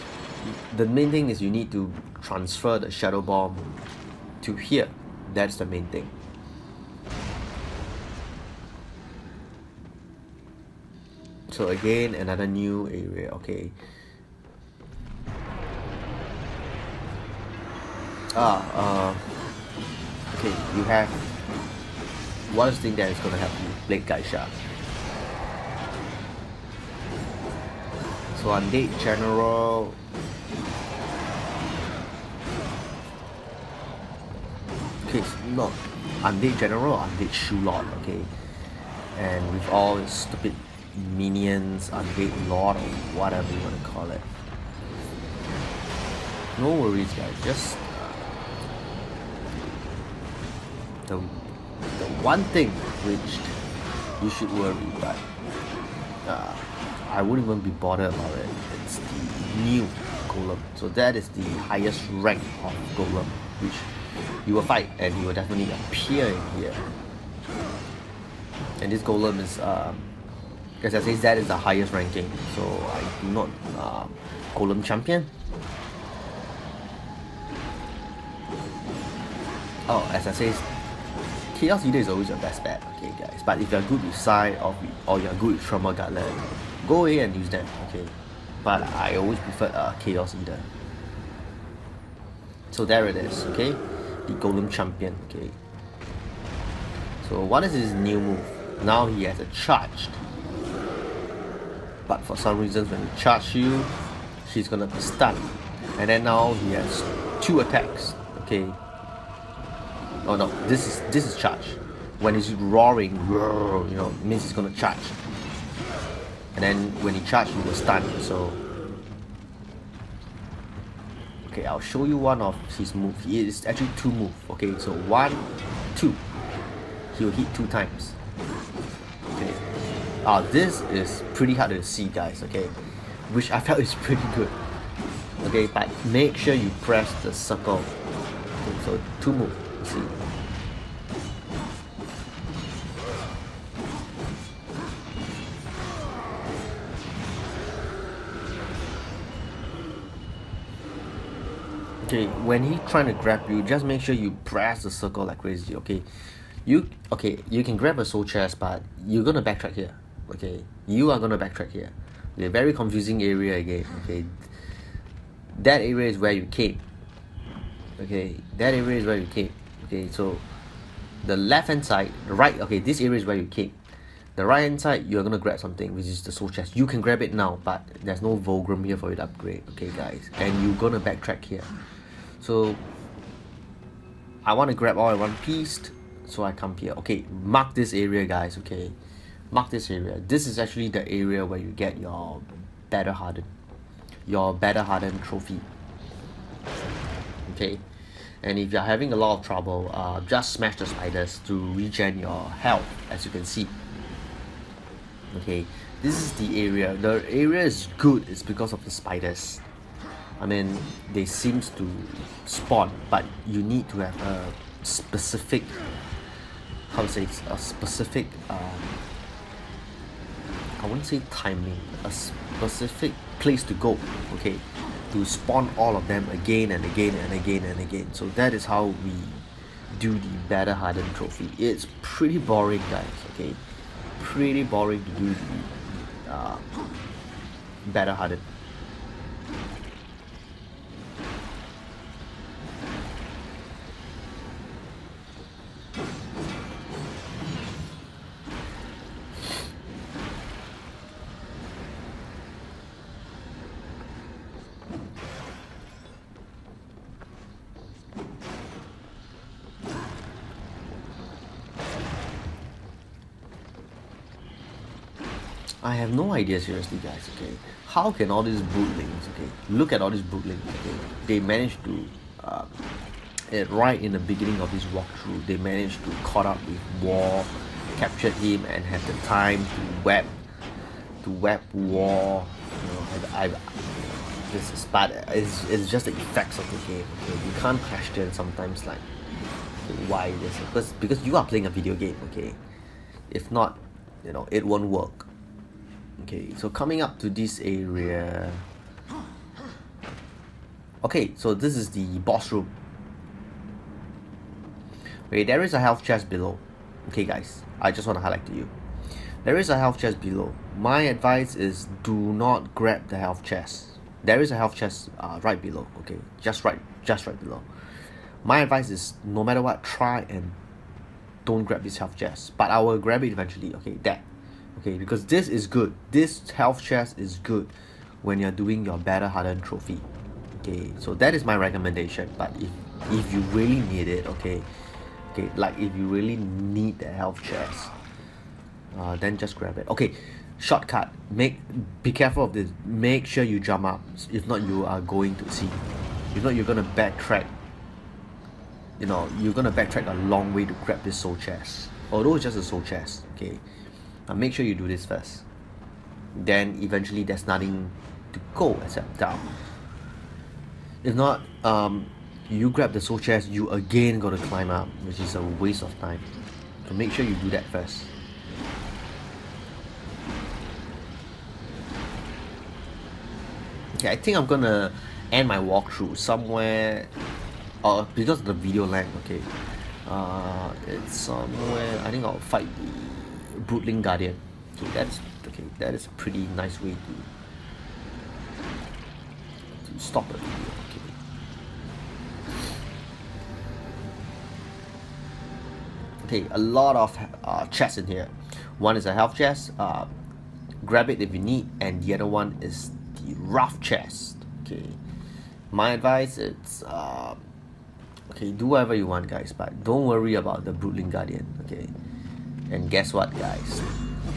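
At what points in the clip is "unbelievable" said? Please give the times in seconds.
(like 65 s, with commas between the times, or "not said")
not said.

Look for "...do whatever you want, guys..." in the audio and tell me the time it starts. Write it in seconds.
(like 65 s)
408 s.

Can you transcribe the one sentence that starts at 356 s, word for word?
Then eventually there's nothing to go except down.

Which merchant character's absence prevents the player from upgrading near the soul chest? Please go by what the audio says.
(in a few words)
Vulgrim.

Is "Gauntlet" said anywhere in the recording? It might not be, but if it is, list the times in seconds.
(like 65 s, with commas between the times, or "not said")
85 s.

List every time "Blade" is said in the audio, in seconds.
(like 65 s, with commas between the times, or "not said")
23 s.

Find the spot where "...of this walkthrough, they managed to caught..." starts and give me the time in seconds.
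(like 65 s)
274 s.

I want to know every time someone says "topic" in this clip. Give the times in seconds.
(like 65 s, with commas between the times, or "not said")
not said.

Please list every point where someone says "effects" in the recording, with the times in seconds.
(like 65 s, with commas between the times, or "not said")
286 s.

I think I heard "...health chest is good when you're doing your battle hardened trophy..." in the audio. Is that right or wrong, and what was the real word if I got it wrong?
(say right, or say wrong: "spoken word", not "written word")
right.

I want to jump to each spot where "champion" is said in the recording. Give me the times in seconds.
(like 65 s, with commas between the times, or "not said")
74 s, 94 s.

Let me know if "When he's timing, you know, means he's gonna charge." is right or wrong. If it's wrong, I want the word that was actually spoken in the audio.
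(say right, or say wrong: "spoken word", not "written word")
wrong: "roaring", not "timing".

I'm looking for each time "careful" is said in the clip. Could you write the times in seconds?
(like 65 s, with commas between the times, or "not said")
342 s.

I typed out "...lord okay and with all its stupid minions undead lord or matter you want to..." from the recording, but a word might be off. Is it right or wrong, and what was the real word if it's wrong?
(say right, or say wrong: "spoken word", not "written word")
wrong: "whatever", not "matter".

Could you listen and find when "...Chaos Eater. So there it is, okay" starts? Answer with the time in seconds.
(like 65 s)
90 s.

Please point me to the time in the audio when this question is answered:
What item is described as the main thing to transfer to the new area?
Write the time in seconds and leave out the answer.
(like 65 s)
2 s.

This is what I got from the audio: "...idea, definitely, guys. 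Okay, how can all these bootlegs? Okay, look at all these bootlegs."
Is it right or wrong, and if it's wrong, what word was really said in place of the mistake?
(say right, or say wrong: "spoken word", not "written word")
wrong: "seriously", not "definitely".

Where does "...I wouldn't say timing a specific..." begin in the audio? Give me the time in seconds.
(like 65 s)
220 s.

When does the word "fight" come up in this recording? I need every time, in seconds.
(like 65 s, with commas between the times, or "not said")
64 s, 382 s.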